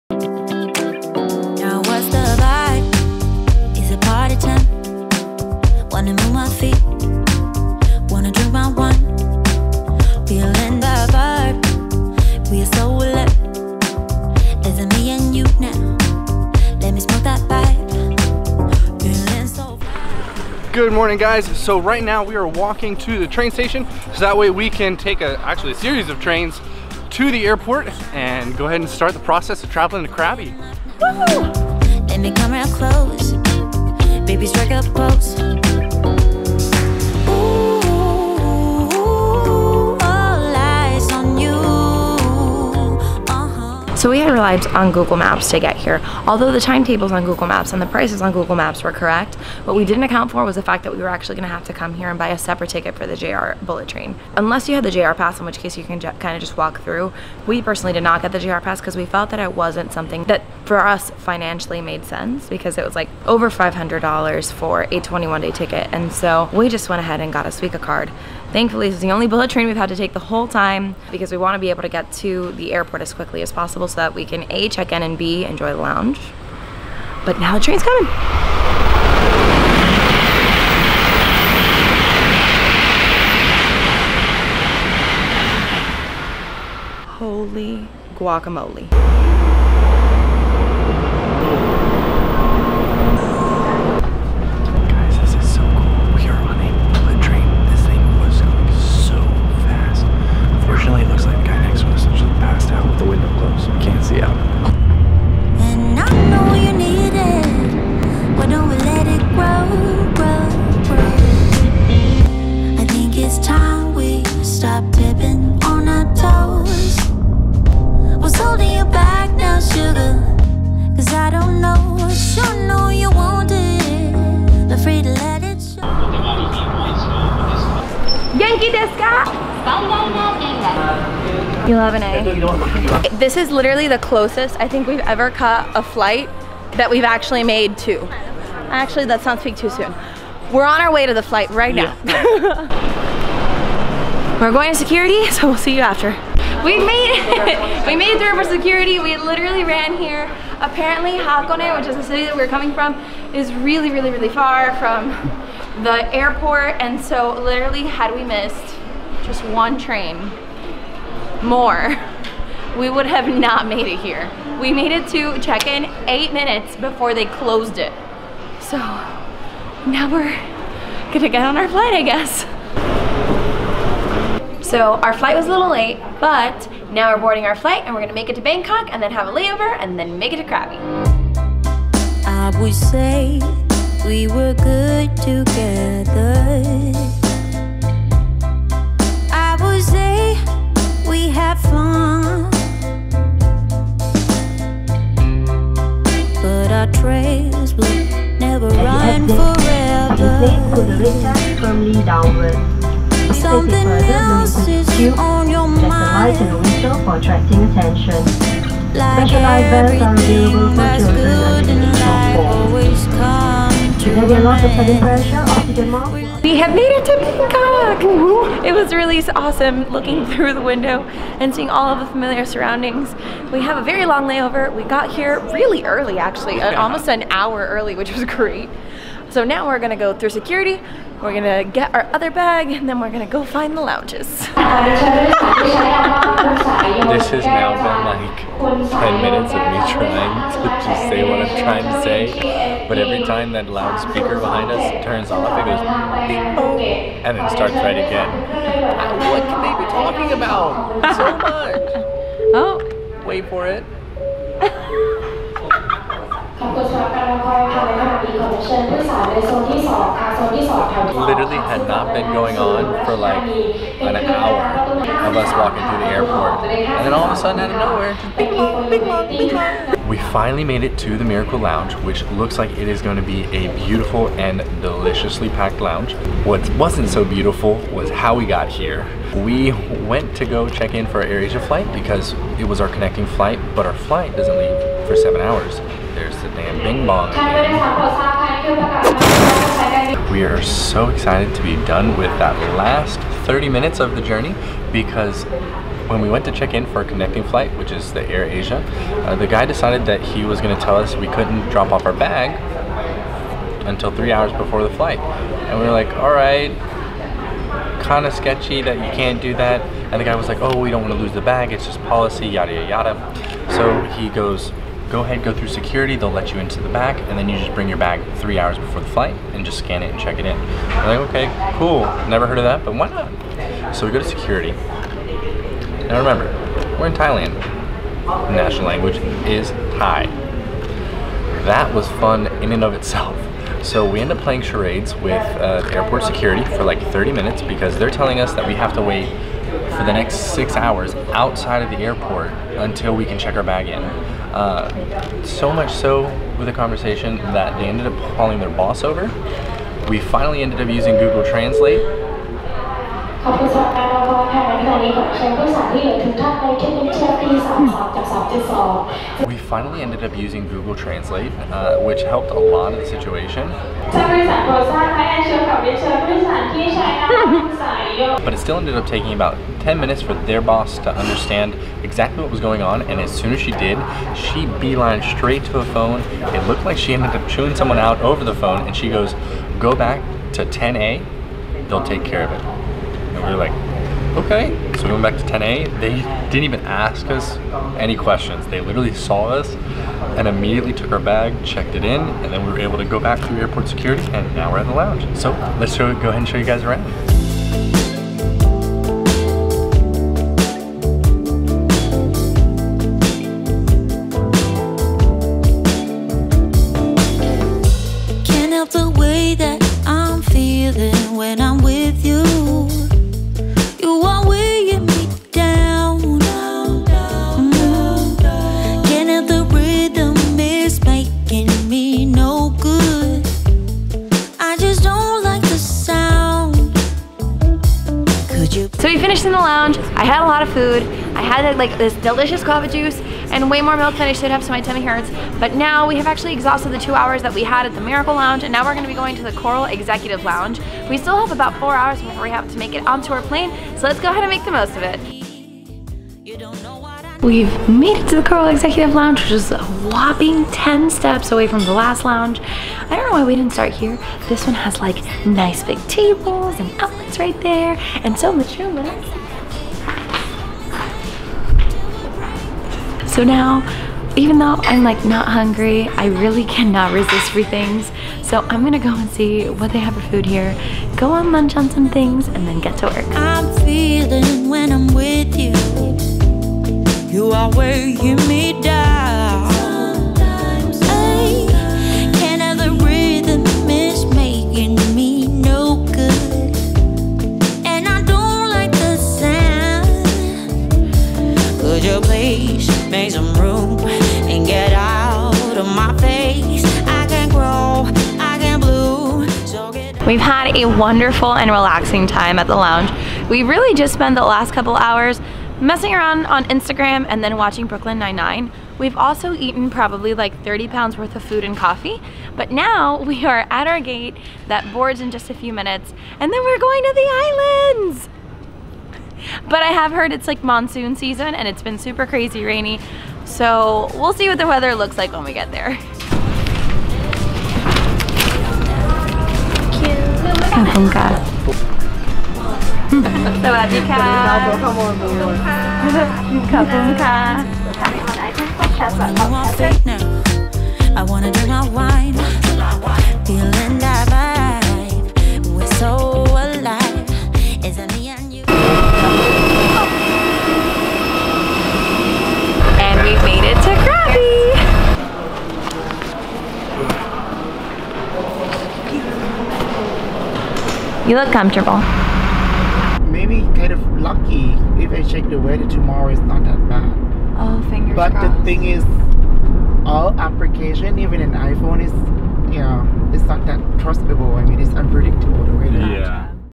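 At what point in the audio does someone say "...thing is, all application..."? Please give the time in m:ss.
9:28.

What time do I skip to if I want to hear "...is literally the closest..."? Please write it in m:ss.
2:13.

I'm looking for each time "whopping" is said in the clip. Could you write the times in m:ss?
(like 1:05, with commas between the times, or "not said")
7:29.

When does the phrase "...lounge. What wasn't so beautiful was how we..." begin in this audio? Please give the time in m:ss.
4:35.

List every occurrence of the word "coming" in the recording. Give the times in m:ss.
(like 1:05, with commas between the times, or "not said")
1:17, 2:32.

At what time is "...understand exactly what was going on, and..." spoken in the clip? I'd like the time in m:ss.
6:11.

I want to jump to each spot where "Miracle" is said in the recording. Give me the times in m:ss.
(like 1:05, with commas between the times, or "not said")
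4:31, 7:18.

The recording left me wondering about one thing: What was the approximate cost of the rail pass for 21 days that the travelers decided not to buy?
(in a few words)
over $500.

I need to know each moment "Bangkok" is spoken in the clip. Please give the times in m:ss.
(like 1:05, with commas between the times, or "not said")
2:58, 3:37.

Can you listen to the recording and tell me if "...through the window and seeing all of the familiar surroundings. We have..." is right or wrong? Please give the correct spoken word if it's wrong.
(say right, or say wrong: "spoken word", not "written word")
right.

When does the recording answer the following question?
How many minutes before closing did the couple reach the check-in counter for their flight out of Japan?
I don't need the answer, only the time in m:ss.
2:46.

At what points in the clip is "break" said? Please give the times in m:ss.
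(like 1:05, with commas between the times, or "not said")
not said.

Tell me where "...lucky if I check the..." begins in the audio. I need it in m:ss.
9:24.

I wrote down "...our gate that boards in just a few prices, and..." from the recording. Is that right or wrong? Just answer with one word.
wrong.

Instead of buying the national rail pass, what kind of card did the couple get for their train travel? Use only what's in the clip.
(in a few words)
Suica card.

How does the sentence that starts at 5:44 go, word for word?
Uh, so much so with the conversation that they ended up calling their boss over.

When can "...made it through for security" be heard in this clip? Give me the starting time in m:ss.
2:27.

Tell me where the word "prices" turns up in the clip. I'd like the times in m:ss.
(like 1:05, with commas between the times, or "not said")
0:47.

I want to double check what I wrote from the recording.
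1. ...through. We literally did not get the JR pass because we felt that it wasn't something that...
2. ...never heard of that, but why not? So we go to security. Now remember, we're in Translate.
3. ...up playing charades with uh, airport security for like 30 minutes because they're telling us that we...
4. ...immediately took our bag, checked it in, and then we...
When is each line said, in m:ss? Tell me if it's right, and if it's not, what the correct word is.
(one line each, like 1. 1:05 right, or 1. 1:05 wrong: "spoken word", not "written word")
1. 0:56 wrong: "personally", not "literally"
2. 5:22 wrong: "Thailand", not "Translate"
3. 5:34 right
4. 6:30 right.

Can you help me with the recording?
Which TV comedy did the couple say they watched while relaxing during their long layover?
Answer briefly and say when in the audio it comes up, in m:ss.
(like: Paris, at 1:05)
Brooklyn Nine-Nine, at 8:27.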